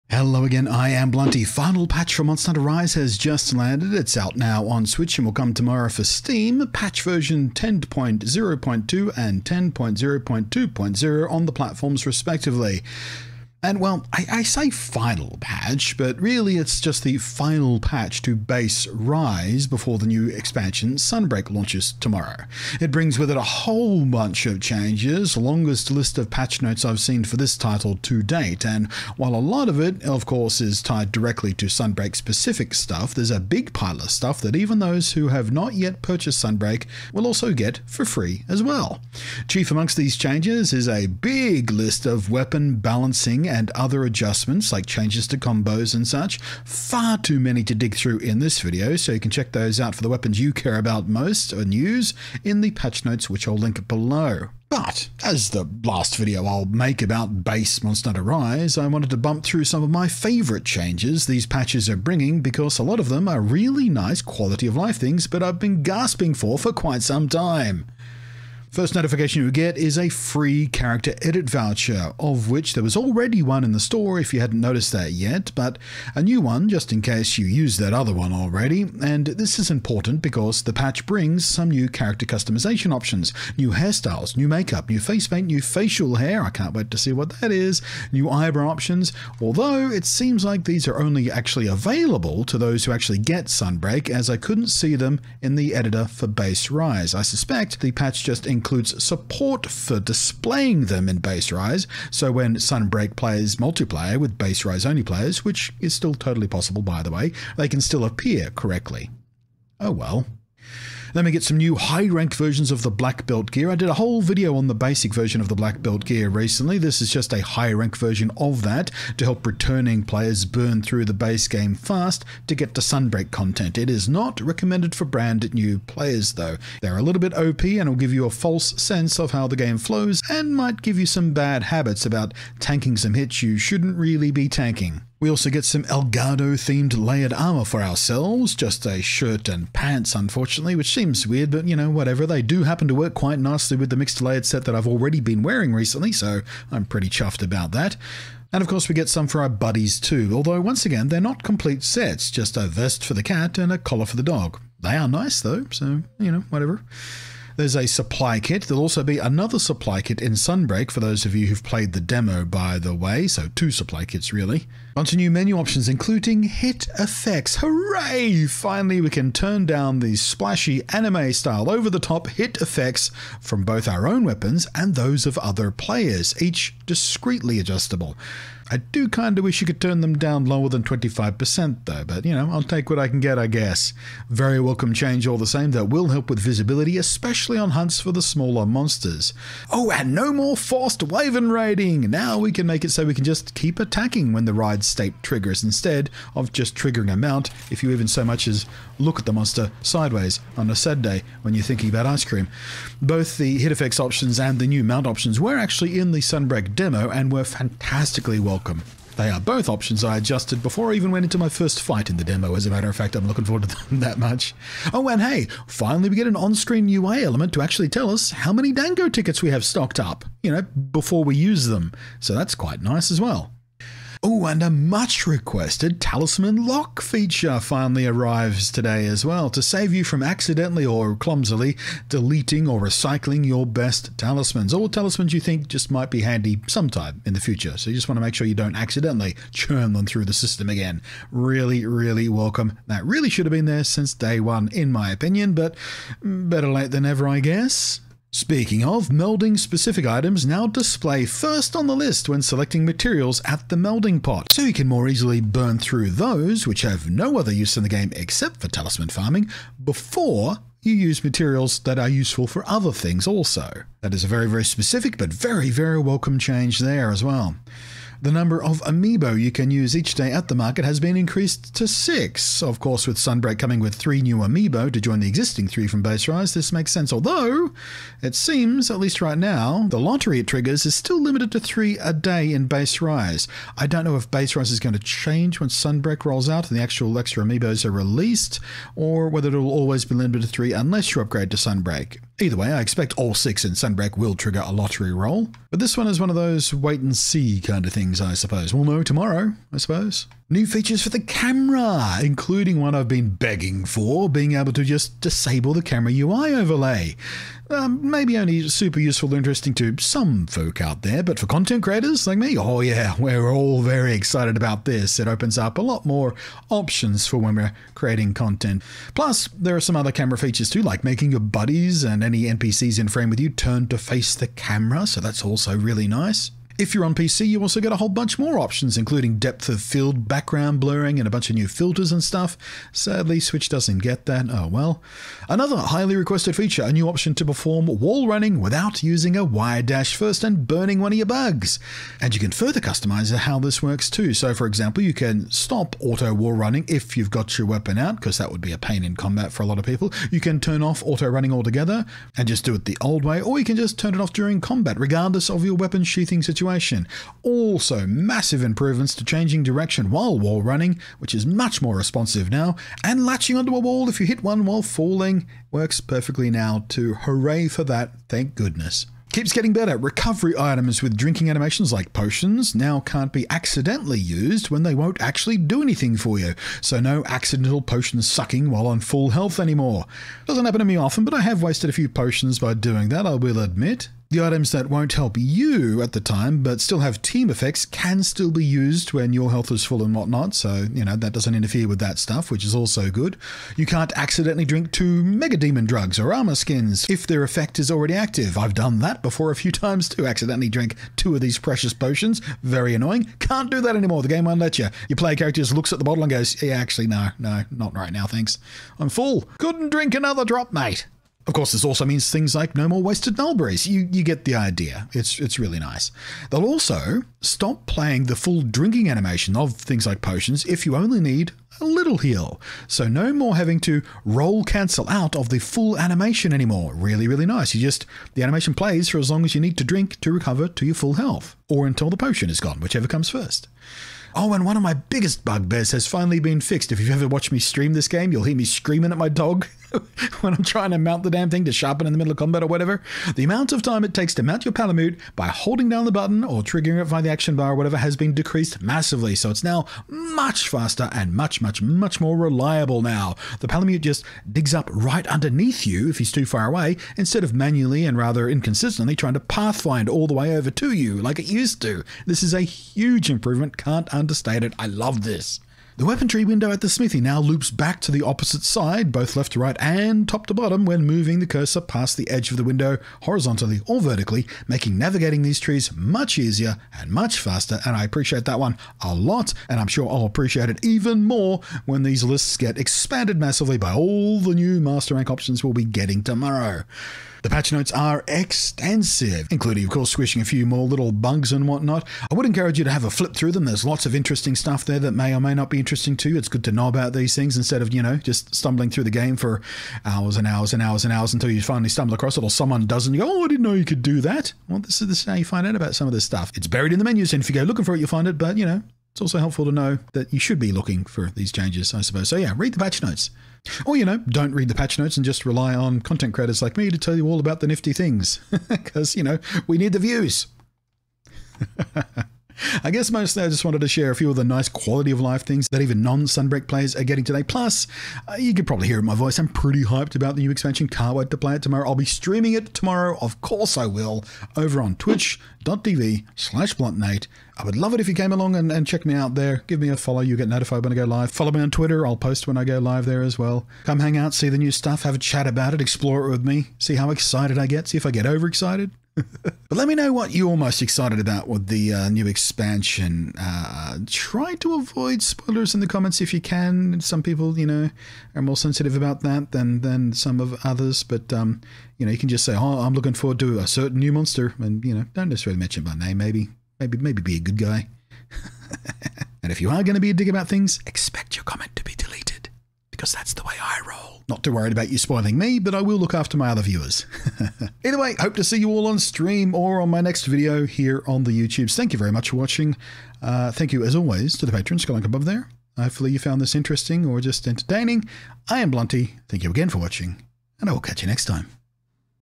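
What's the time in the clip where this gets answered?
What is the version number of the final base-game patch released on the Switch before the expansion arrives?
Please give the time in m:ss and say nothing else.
0:07.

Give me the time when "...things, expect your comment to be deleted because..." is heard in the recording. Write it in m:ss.
9:30.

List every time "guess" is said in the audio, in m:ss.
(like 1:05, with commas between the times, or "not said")
3:03, 4:07, 8:42.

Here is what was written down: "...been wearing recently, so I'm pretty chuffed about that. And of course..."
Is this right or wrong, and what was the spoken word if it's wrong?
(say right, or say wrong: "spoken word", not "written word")
right.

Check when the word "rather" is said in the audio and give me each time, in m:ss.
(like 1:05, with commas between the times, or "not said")
7:38.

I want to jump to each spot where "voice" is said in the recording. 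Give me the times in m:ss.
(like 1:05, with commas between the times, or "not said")
8:49.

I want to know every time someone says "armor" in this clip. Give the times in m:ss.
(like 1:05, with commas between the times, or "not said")
2:17, 6:36.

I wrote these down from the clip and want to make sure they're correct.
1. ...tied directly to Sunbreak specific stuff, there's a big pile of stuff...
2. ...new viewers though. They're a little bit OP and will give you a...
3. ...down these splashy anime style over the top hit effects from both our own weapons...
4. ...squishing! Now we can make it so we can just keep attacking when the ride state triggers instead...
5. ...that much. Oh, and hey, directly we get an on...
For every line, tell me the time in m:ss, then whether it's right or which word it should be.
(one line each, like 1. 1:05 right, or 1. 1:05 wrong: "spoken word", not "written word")
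1. 0:30 right
2. 2:05 wrong: "players", not "viewers"
3. 2:49 right
4. 3:11 wrong: "riding", not "squishing"
5. 3:33 wrong: "finally", not "directly".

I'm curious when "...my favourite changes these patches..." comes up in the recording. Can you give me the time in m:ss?
0:59.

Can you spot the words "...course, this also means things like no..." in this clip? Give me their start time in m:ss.
6:51.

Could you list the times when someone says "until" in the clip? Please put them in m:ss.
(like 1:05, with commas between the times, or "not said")
7:11, 8:21.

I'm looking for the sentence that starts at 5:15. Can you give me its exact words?
It opens up a lot more options for when we're creating content.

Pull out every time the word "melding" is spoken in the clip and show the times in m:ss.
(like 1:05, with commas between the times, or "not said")
4:09, 4:13.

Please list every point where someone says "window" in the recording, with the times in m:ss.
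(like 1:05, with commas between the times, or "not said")
7:46, 7:52.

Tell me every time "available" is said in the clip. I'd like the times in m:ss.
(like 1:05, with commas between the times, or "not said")
1:31.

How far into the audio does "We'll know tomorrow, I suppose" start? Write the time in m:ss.
4:58.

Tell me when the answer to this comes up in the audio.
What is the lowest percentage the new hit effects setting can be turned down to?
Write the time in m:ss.
3:00.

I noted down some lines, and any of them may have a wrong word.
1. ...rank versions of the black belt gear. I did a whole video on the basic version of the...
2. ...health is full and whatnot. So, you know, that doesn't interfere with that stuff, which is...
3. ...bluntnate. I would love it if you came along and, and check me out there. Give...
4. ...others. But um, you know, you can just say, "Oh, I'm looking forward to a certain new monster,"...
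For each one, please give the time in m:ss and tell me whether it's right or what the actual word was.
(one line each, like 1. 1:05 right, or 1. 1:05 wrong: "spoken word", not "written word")
1. 1:52 right
2. 6:29 right
3. 8:56 right
4. 9:20 right.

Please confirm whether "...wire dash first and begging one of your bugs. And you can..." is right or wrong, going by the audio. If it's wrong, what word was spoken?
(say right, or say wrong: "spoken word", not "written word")
wrong: "burning", not "begging".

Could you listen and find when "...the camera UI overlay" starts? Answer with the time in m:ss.
5:05.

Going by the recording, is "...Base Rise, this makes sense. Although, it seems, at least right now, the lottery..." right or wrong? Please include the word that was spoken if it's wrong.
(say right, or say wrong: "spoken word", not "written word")
right.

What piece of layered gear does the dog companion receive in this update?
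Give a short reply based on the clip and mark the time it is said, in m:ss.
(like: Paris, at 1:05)
a collar, at 2:33.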